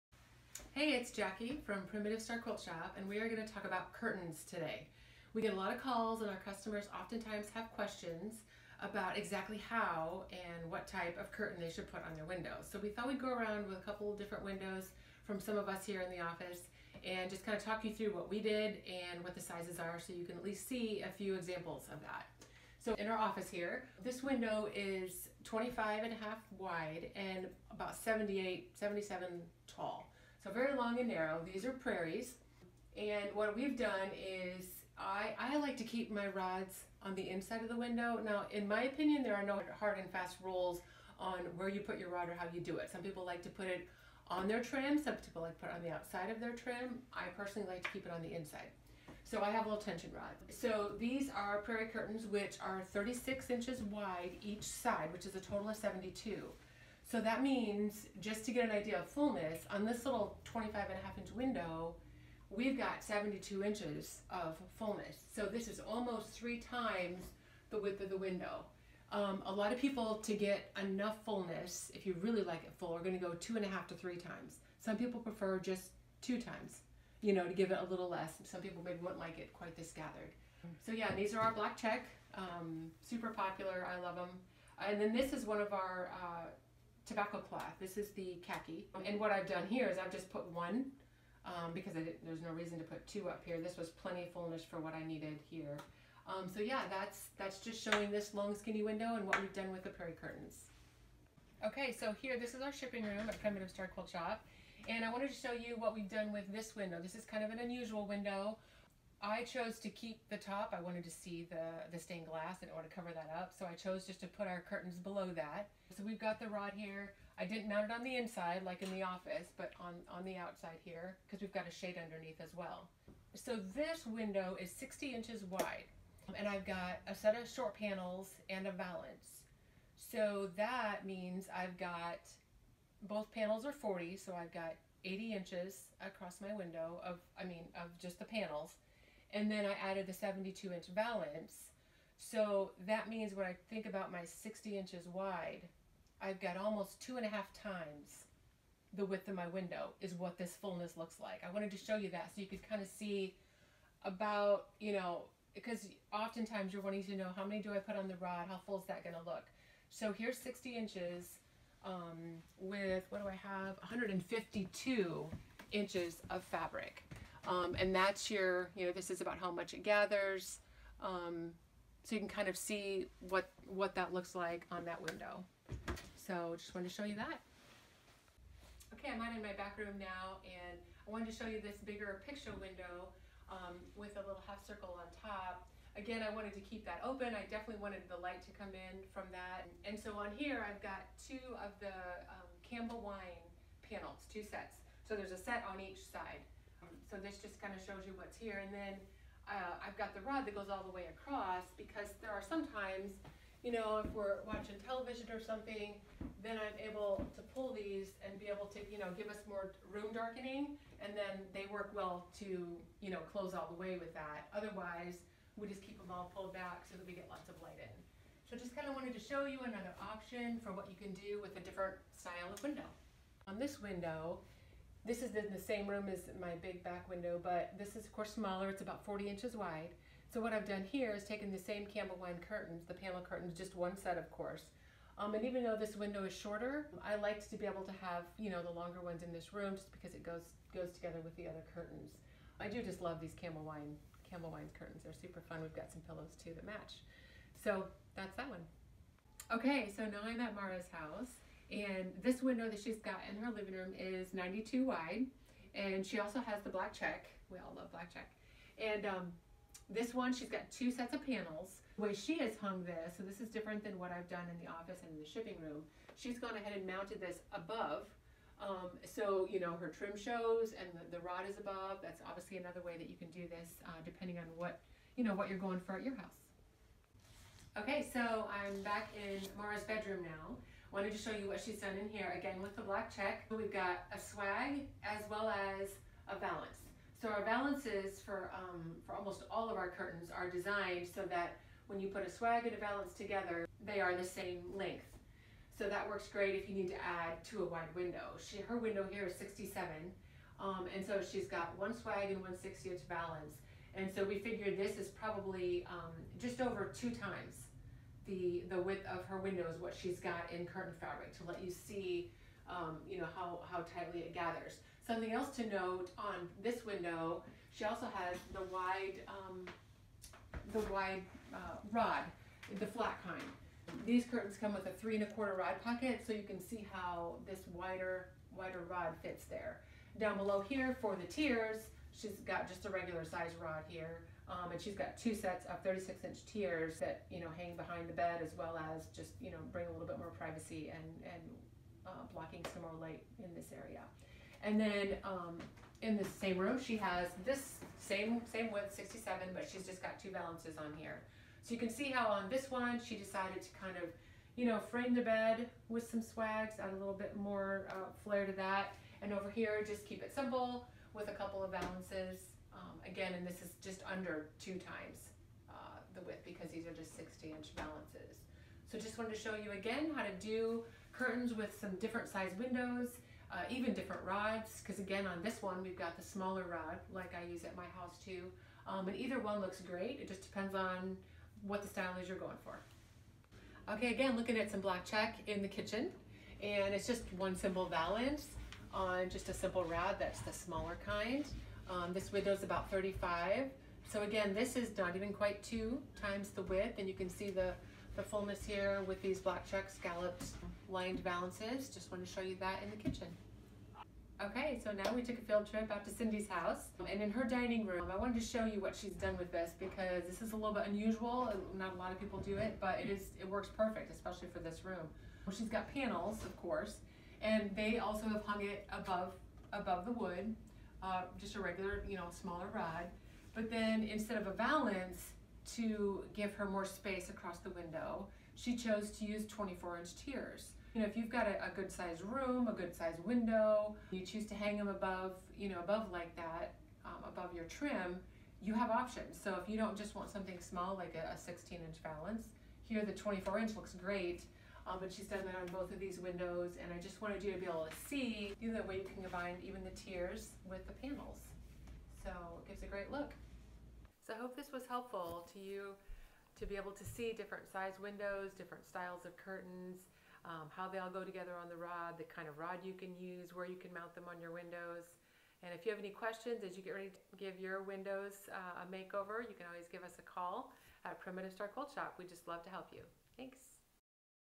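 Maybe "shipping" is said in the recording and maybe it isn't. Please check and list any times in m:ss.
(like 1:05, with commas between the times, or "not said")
1:42, 4:25.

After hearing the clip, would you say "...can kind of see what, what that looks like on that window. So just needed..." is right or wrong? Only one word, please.
wrong.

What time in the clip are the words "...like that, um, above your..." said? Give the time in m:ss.
7:16.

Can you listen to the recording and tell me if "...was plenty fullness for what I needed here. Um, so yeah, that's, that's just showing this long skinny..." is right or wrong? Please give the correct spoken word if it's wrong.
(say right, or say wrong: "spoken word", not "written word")
right.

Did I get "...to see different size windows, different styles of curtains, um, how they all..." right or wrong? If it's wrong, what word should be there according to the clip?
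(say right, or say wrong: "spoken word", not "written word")
right.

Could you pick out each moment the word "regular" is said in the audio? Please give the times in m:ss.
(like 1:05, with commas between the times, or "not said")
5:32, 7:01.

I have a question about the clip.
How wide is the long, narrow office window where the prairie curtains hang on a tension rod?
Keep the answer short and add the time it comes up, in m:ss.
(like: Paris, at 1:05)
25 and a half inches, at 0:25.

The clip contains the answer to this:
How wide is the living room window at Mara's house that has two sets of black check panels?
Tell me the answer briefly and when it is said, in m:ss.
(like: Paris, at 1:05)
92 inches, at 4:14.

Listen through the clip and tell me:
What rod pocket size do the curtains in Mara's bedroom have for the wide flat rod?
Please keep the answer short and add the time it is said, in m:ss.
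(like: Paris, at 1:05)
3 and a quarter inches, at 5:24.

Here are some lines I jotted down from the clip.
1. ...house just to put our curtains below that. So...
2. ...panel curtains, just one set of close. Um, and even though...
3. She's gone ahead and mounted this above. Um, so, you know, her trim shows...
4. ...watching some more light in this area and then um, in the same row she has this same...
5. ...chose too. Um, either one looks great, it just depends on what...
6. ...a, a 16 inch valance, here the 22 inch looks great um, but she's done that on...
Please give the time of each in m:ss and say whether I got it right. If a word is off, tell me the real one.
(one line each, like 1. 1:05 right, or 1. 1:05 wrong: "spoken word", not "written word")
1. 1:53 wrong: "chose", not "house"
2. 3:52 wrong: "course", not "close"
3. 4:26 right
4. 5:42 wrong: "blocking", not "watching"
5. 6:17 wrong: "house", not "chose"
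6. 7:21 wrong: "24", not "22".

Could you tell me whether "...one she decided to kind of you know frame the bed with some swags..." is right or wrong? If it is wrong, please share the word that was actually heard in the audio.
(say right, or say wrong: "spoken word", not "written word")
right.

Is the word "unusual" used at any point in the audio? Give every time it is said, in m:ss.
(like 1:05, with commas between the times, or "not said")
1:47, 6:50.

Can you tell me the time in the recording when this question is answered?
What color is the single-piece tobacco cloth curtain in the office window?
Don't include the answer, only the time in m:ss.
1:28.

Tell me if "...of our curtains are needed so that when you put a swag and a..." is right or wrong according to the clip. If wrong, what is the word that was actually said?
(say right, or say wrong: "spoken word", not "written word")
wrong: "designed", not "needed".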